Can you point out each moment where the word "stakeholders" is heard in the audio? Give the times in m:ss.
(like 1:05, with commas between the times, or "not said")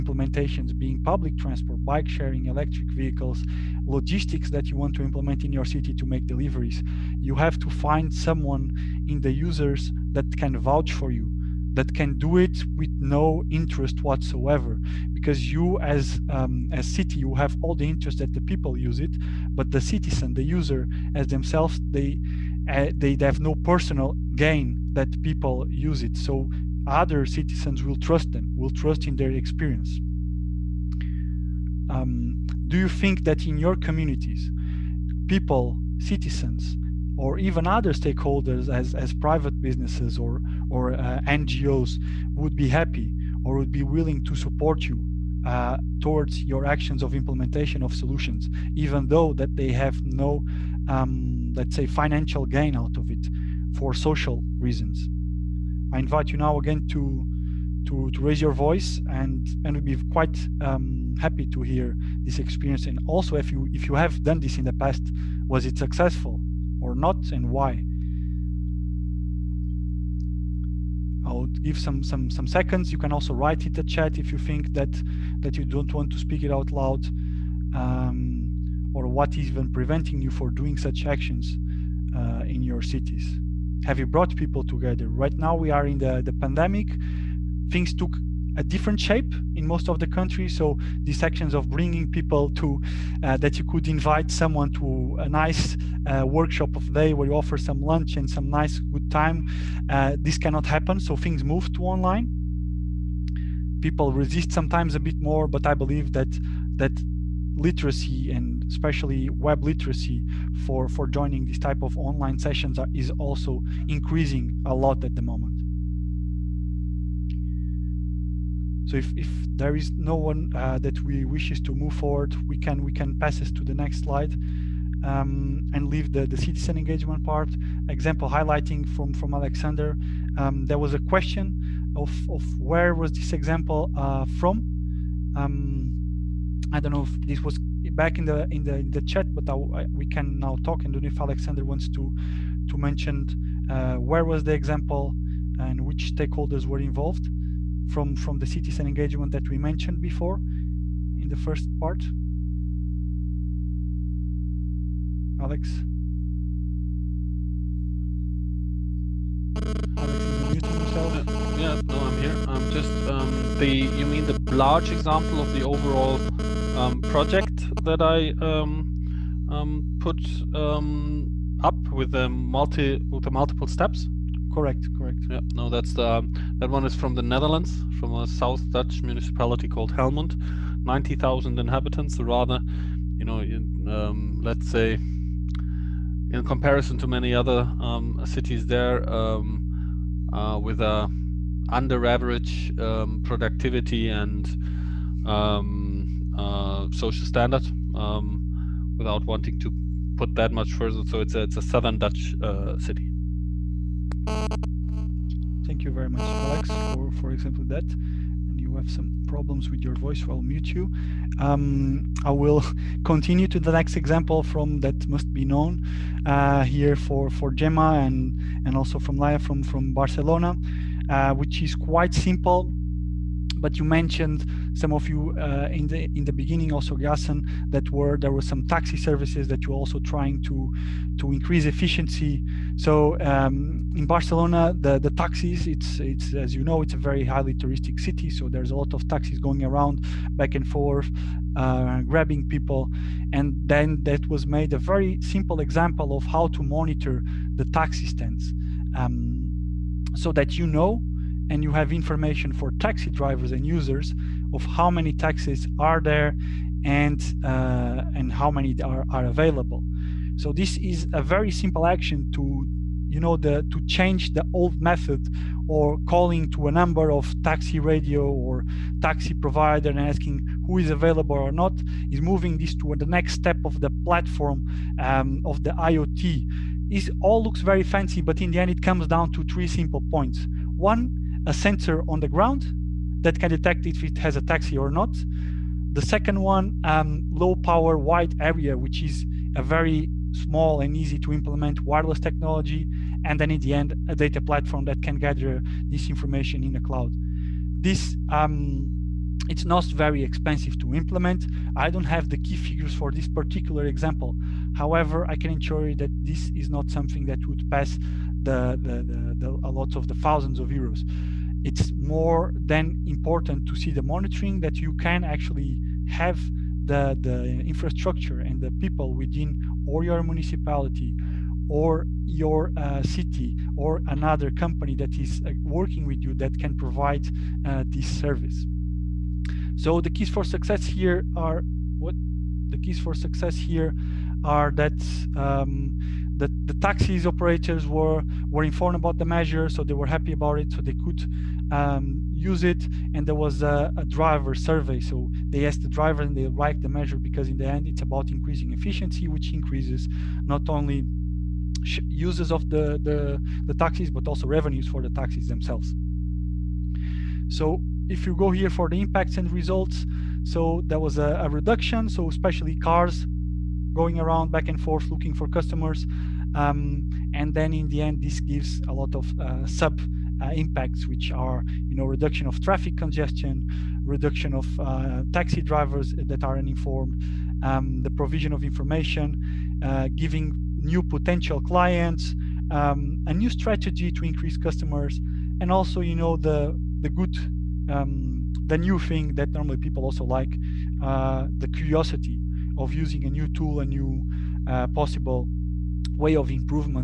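0:37, 2:26.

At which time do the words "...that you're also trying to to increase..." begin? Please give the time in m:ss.
3:49.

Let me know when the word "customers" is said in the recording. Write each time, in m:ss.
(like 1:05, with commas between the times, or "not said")
6:05, 6:24.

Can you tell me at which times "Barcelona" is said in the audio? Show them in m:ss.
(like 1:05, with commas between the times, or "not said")
3:39, 3:54.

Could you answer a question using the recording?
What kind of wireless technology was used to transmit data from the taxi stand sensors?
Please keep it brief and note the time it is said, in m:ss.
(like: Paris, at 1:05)
low power wide area, at 4:47.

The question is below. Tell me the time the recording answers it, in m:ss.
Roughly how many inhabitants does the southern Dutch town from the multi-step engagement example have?
3:00.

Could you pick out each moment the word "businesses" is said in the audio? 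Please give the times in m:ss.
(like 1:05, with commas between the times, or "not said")
0:39.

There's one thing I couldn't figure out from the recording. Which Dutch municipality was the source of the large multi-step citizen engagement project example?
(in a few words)
Helmond.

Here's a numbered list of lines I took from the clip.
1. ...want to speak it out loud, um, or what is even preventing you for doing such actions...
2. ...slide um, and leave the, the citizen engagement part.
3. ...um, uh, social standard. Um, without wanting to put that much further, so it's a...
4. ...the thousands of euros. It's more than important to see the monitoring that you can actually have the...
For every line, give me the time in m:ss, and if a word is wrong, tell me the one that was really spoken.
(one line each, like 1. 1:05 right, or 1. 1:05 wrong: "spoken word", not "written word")
1. 1:15 right
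2. 2:04 right
3. 3:15 right
4. 5:10 right.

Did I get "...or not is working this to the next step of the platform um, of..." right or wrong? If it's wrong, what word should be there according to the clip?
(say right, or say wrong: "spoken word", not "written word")
wrong: "moving", not "working".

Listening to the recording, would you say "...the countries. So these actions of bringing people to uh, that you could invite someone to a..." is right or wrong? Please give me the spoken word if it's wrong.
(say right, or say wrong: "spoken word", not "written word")
right.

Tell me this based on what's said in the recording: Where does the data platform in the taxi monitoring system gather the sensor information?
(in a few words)
in the cloud.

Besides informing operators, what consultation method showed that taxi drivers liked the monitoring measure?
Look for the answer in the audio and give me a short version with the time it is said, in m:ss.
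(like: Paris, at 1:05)
a driver survey, at 5:44.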